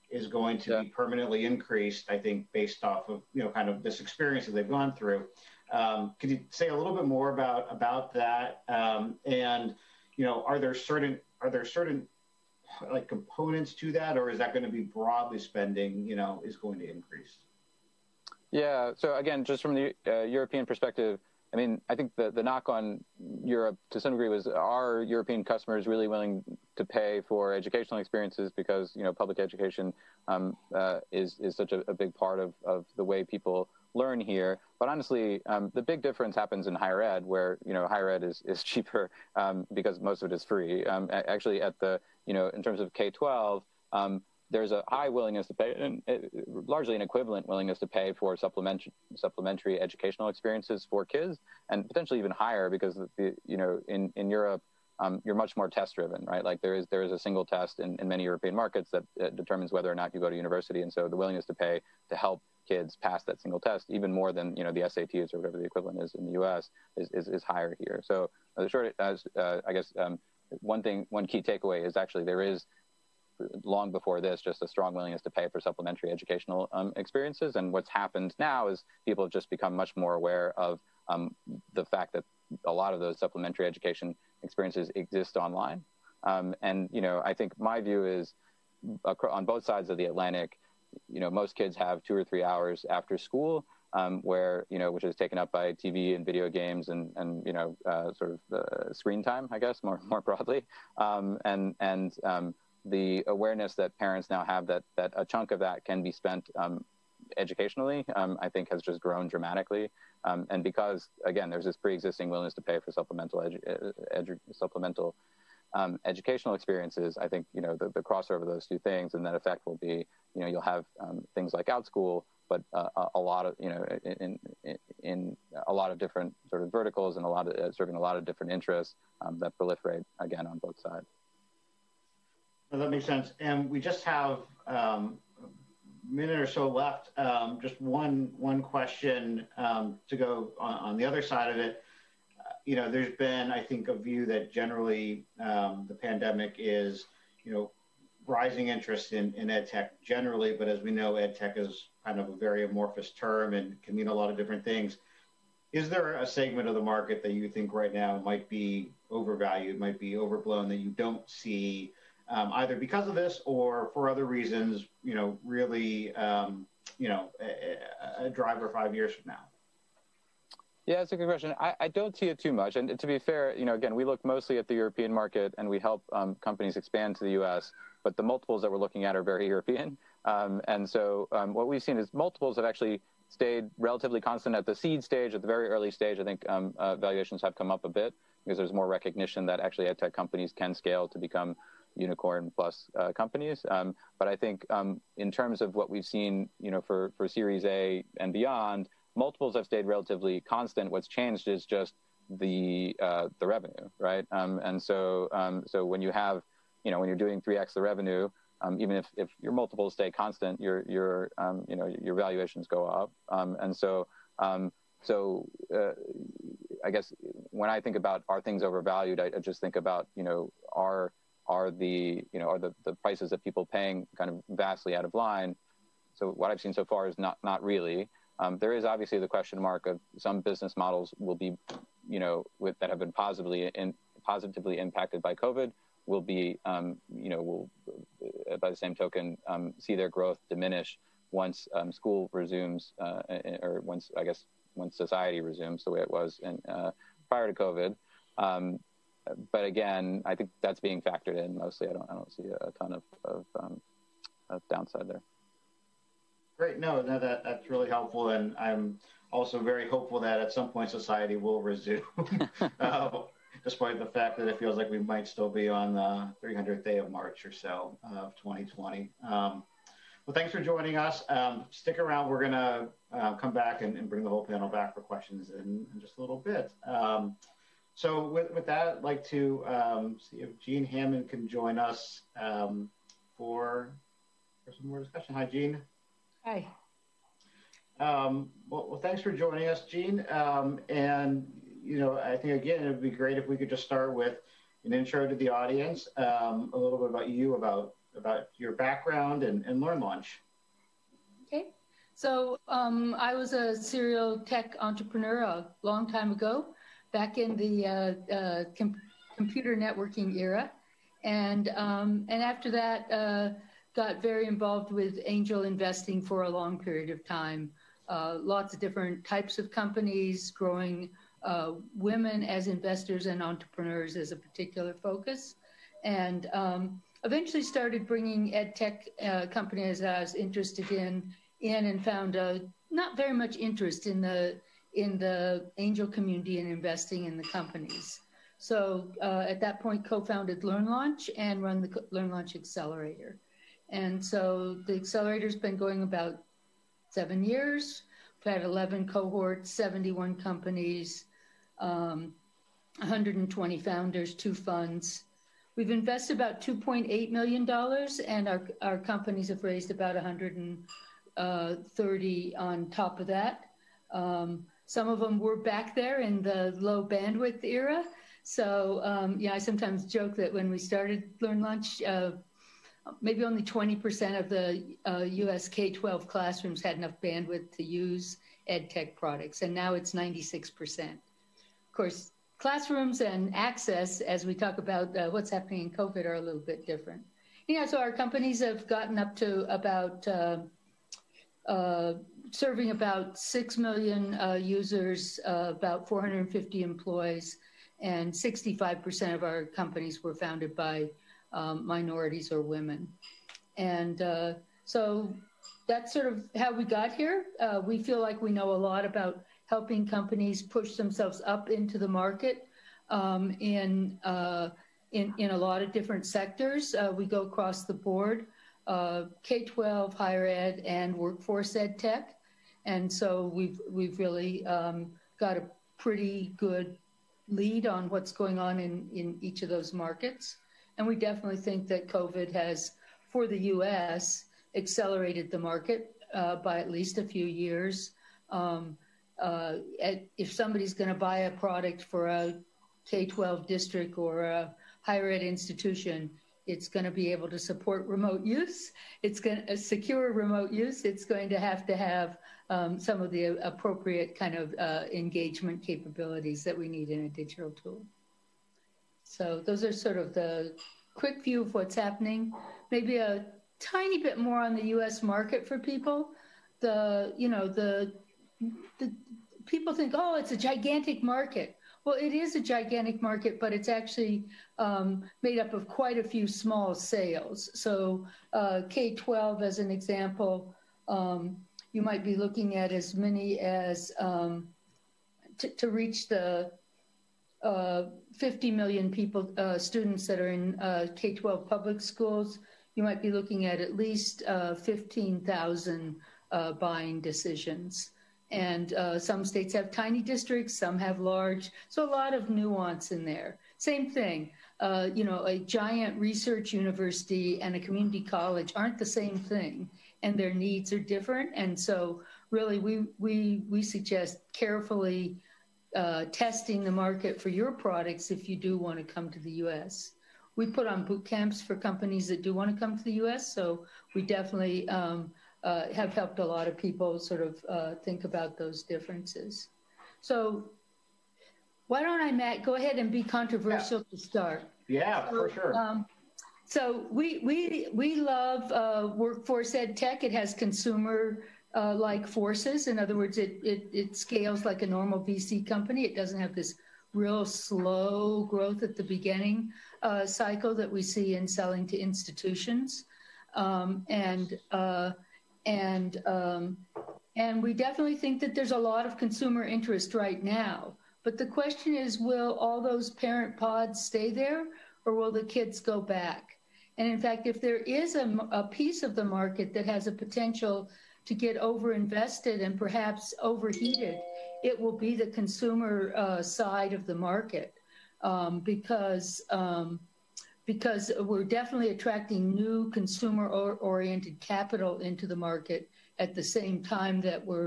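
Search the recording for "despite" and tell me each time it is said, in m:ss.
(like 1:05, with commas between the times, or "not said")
4:23.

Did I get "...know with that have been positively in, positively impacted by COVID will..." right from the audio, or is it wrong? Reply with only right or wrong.
right.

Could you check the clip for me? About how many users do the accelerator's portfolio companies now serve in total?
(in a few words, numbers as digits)
6 million.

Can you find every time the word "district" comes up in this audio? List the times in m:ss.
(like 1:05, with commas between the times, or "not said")
7:23, 8:20.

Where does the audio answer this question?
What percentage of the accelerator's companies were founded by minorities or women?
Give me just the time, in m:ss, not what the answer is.
6:38.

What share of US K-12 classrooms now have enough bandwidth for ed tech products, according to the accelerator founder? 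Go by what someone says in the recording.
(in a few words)
96%.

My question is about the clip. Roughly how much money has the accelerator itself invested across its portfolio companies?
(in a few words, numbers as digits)
$2.8 million.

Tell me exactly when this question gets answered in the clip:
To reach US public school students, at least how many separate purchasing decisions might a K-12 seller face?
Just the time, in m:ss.
8:14.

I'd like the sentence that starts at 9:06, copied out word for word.
It doesn't have this real slow growth at the beginning uh, cycle that we see in selling to institutions.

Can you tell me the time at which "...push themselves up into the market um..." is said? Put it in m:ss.
6:50.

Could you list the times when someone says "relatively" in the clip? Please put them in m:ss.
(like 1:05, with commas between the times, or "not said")
3:03, 3:19.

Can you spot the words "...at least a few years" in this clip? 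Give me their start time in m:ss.
7:16.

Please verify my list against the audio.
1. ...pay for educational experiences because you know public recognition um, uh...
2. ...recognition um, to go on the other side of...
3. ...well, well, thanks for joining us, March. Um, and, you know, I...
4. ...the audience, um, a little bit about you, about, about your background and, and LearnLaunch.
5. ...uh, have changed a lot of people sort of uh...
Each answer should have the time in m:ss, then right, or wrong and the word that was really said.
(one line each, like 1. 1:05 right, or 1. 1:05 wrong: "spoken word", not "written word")
1. 0:26 wrong: "education", not "recognition"
2. 2:18 wrong: "question", not "recognition"
3. 4:48 wrong: "Jean", not "March"
4. 4:55 right
5. 8:45 wrong: "helped", not "changed".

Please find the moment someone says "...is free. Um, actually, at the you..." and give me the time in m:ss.
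0:40.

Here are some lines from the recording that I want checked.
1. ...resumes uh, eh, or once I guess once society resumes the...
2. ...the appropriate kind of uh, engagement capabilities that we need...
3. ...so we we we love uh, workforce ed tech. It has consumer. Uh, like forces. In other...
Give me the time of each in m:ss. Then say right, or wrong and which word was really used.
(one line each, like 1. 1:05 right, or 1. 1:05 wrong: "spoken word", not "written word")
1. 4:02 right
2. 7:33 right
3. 8:56 right.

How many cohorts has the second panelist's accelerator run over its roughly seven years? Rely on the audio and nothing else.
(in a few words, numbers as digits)
11.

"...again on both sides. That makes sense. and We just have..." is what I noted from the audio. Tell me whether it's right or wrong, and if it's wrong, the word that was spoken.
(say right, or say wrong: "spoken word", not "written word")
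right.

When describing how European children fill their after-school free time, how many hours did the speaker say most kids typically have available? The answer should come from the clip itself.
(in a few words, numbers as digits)
2 or 3 hours.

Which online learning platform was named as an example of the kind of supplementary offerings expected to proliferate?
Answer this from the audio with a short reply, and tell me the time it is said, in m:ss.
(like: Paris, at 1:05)
Outschool, at 2:01.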